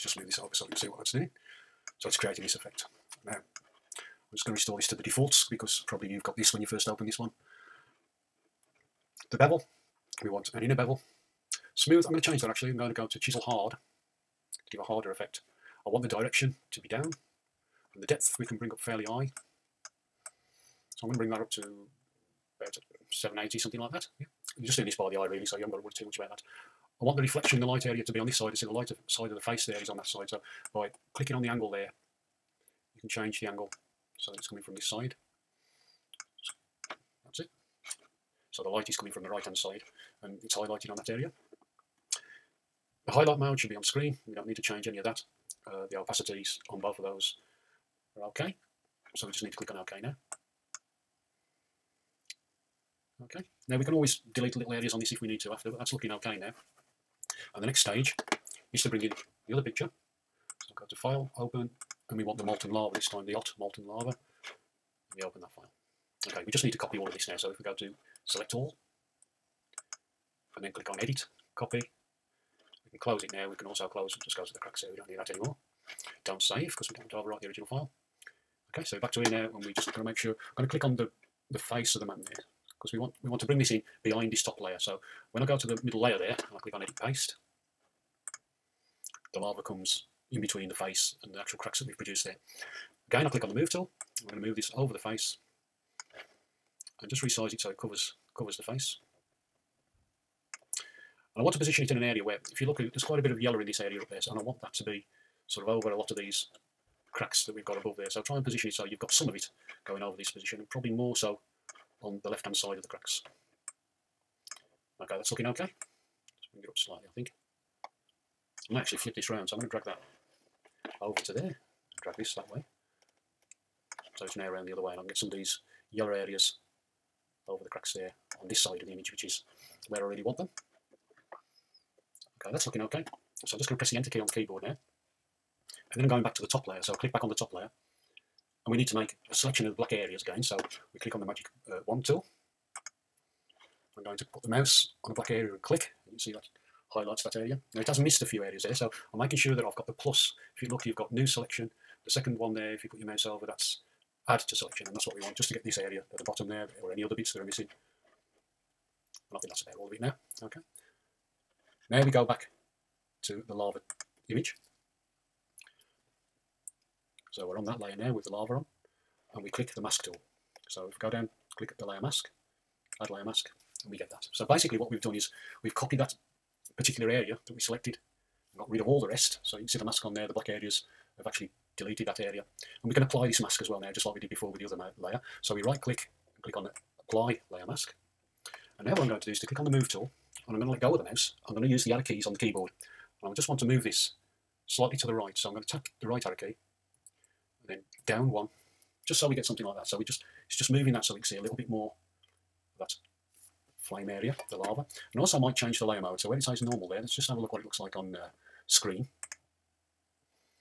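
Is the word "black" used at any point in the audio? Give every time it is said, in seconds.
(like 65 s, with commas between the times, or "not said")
139 s, 145 s, 180 s.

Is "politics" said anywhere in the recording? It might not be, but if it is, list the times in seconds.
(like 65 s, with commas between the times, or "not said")
not said.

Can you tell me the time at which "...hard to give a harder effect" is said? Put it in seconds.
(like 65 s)
13 s.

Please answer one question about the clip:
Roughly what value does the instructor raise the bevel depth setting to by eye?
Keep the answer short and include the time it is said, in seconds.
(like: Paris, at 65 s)
780, at 23 s.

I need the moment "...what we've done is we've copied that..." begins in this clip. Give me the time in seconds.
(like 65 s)
174 s.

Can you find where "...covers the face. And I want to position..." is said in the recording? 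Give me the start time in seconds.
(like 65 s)
98 s.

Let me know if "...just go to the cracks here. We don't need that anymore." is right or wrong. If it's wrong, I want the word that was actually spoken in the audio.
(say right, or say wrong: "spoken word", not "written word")
right.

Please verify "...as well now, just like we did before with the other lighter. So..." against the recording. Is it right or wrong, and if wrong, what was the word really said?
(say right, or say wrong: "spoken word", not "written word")
wrong: "layer", not "lighter".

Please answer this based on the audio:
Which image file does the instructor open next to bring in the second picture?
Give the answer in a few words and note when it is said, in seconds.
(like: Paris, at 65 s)
Hot molten lava, at 63 s.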